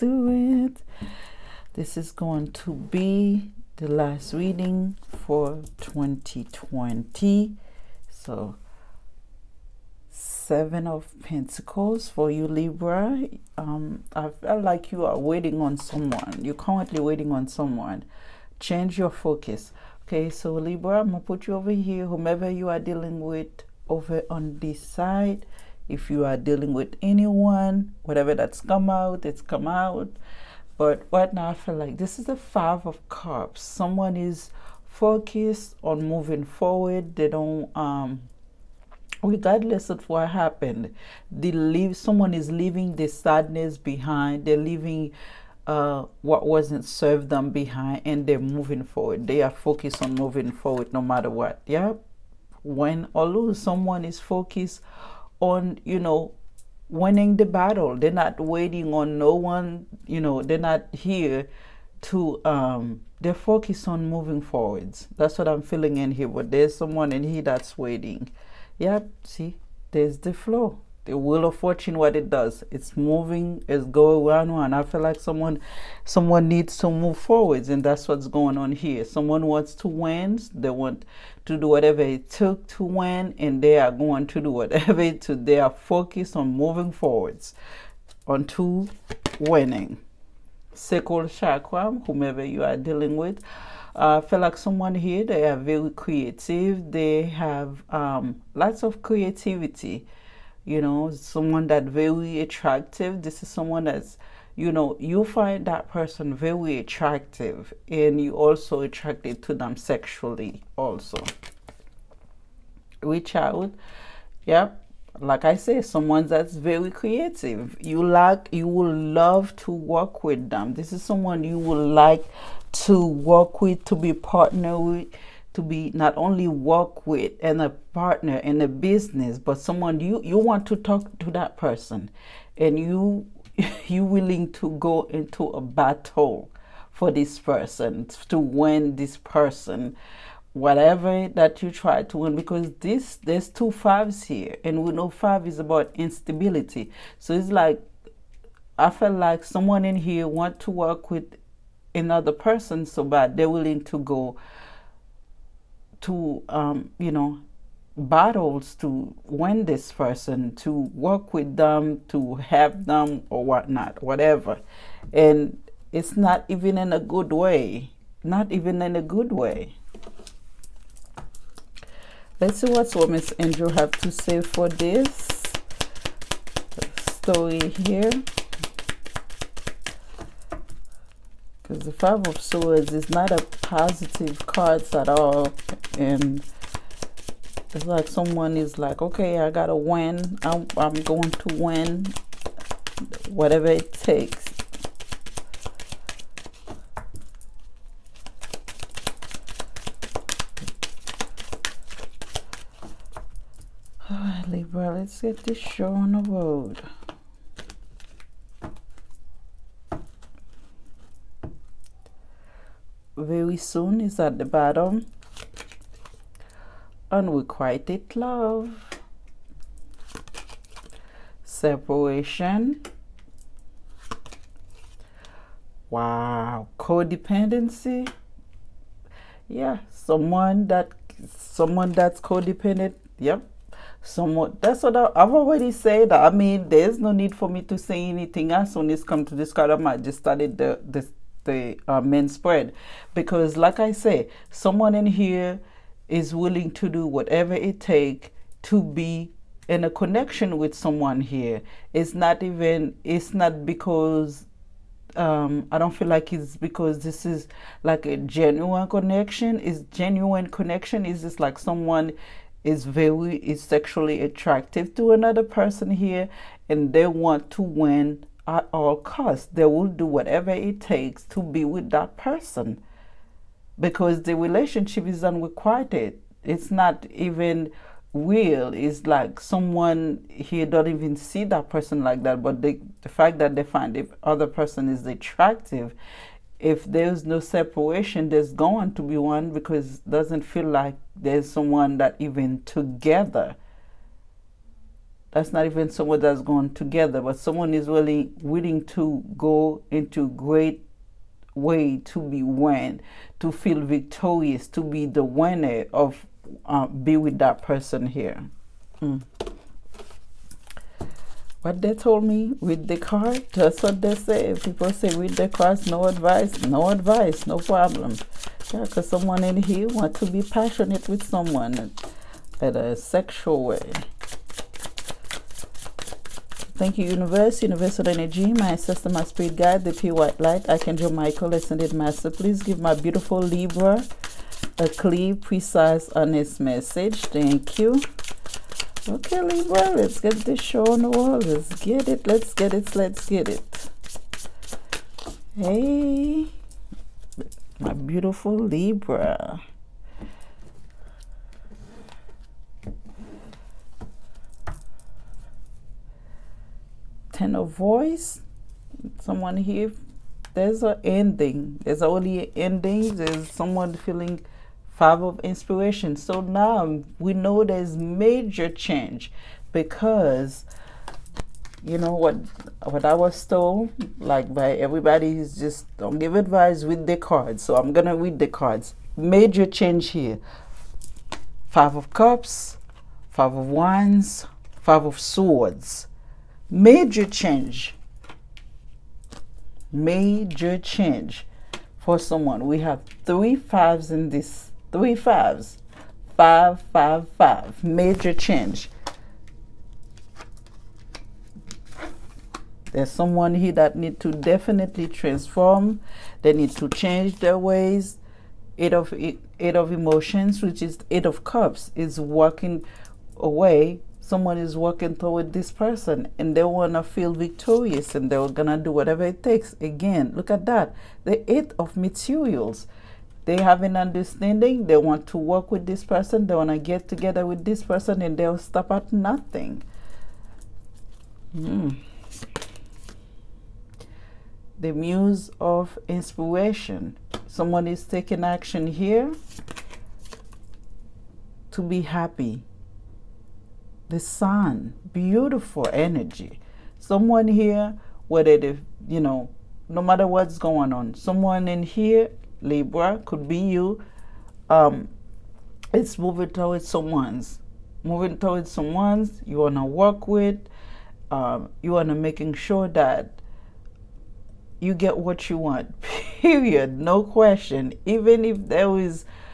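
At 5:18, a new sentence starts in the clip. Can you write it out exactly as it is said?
Yeah, because someone in here want to be passionate with someone in a sexual way.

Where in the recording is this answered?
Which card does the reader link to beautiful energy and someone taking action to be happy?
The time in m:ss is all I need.
7:24.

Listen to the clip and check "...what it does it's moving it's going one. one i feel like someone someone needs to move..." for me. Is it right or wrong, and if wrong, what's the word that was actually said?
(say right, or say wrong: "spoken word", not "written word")
right.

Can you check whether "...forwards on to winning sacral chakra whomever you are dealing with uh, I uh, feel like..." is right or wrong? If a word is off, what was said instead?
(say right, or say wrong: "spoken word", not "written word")
right.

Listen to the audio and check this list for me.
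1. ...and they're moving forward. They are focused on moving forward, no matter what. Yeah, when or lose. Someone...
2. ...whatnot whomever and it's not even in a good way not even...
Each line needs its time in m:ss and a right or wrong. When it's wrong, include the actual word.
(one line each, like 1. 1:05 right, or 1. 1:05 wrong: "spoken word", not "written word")
1. 0:48 right
2. 2:43 wrong: "whatever", not "whomever".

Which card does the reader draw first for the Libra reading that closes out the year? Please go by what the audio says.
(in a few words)
Seven of Pentacles.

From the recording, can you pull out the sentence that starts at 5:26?
Thank you, Universe, Universal Energy, my sister, my spirit guide, the pure white light, Archangel Michael, Ascended Master.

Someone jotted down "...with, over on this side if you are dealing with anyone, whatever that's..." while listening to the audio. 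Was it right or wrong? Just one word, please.
right.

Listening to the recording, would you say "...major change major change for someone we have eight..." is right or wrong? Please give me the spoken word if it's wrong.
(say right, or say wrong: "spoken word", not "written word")
wrong: "three", not "eight".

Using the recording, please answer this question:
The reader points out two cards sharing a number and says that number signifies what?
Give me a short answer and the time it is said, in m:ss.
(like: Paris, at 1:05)
instability, at 2:25.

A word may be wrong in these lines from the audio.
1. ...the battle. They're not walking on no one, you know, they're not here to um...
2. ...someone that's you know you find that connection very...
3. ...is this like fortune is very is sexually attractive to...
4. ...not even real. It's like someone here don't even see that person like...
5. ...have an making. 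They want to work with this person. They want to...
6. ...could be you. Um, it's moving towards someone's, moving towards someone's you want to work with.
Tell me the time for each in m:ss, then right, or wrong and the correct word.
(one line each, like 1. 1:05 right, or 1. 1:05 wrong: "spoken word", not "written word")
1. 0:57 wrong: "waiting", not "walking"
2. 1:43 wrong: "person", not "connection"
3. 4:21 wrong: "someone", not "fortune"
4. 4:36 right
5. 7:03 wrong: "understanding", not "making"
6. 7:33 right.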